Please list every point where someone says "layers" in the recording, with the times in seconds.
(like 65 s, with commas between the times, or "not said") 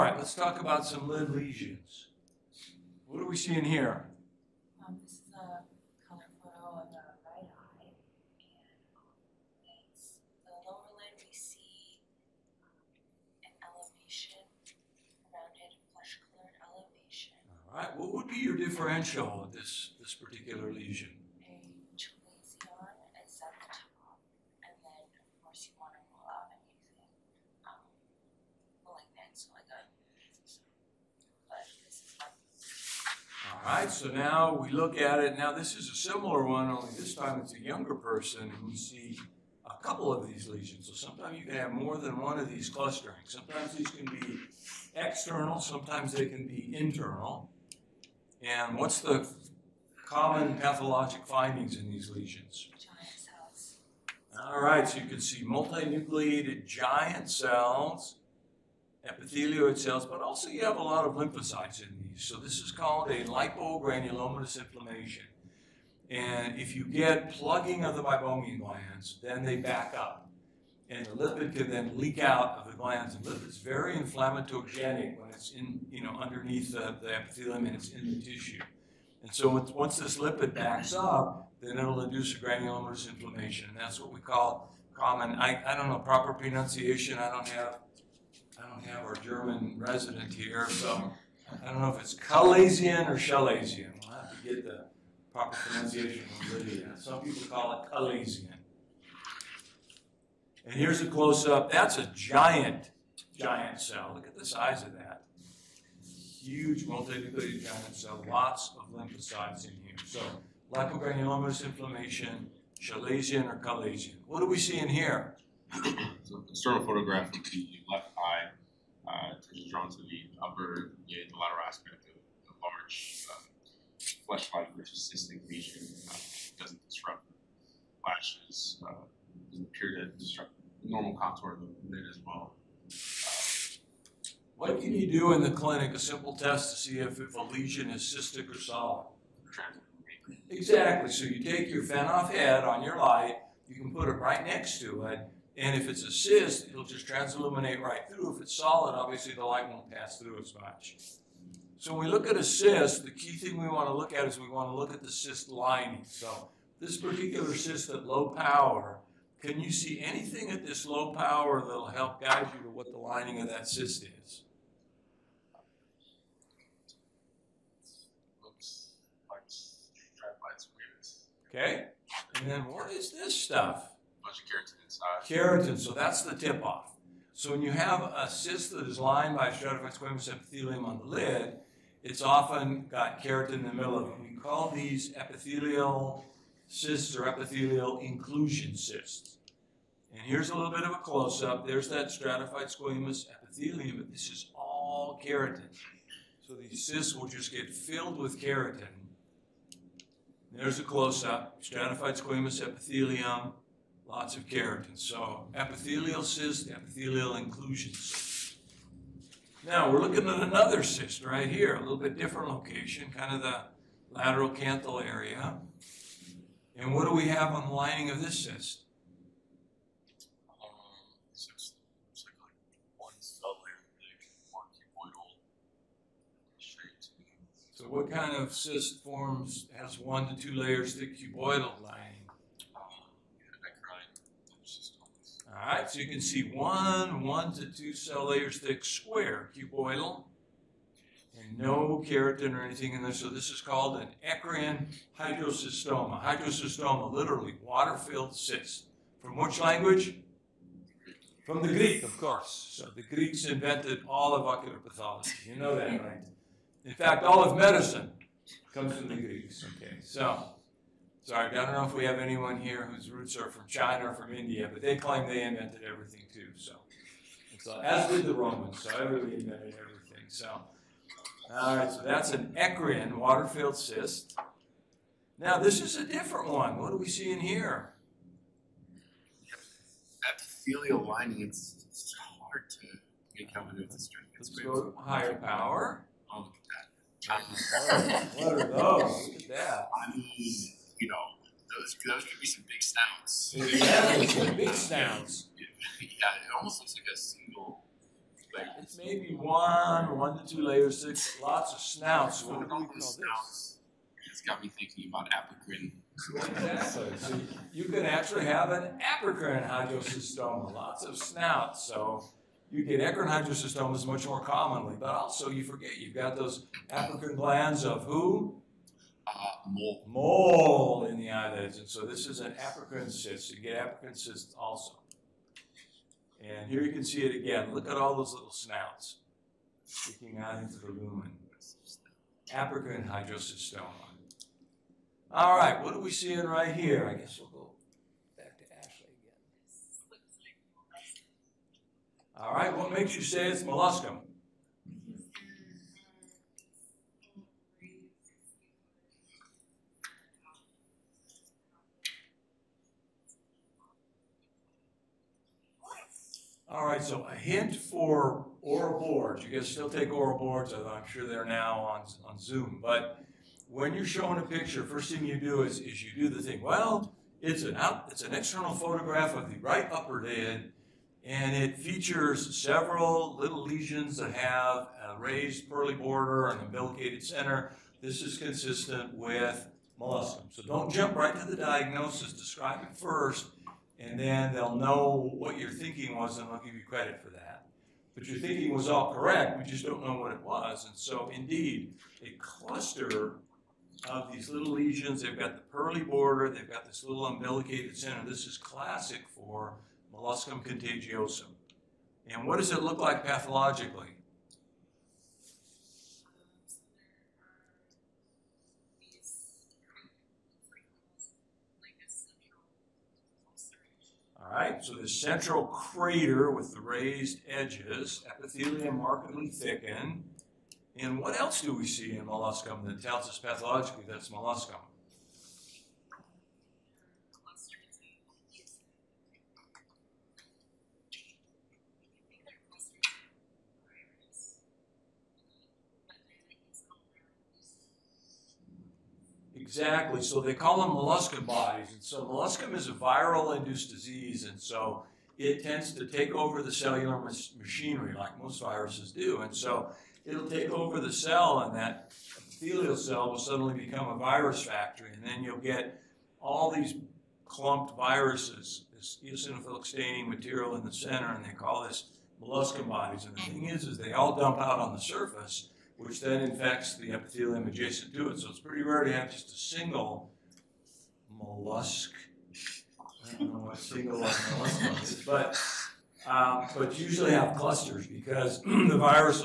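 230 s, 238 s, 300 s.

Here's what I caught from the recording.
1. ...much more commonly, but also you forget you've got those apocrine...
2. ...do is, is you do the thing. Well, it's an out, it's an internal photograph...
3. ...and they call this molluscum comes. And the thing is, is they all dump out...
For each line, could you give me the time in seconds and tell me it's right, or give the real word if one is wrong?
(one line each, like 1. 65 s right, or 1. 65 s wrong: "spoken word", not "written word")
1. 314 s right
2. 365 s wrong: "external", not "internal"
3. 461 s wrong: "bodies", not "comes".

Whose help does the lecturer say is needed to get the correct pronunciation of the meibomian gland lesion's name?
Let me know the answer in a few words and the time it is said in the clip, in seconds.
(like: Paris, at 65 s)
Lydia, at 96 s.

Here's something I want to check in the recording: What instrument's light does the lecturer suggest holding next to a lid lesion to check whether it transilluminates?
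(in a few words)
Finoff head.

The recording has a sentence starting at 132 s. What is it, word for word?
Uh, what can you do in the clinic, a simple test to see if, if a lesion is cystic or solid?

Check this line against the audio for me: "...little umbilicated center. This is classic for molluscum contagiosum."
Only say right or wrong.
right.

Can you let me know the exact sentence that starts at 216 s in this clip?
And what do we have on the lining of this cyst?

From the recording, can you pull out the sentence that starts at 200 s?
There's a close up, stratified squamous epithelium, lots of keratin.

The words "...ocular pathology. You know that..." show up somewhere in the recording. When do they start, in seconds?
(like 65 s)
254 s.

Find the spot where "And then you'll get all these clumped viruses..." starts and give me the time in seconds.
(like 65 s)
455 s.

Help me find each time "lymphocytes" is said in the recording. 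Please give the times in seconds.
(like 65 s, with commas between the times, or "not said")
61 s, 108 s.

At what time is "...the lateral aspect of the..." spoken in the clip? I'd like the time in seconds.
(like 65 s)
121 s.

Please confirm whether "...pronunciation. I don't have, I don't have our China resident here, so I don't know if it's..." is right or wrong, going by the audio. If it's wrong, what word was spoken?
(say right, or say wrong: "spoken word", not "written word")
wrong: "German", not "China".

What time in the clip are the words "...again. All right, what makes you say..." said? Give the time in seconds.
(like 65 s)
342 s.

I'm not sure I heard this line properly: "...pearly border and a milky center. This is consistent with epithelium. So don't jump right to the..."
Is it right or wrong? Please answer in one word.
wrong.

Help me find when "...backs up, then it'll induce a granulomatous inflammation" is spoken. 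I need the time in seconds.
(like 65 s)
80 s.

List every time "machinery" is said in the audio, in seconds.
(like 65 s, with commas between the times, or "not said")
447 s.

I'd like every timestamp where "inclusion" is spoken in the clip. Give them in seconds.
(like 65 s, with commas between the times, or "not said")
187 s, 207 s.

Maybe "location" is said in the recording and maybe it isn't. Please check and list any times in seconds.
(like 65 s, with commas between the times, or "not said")
212 s.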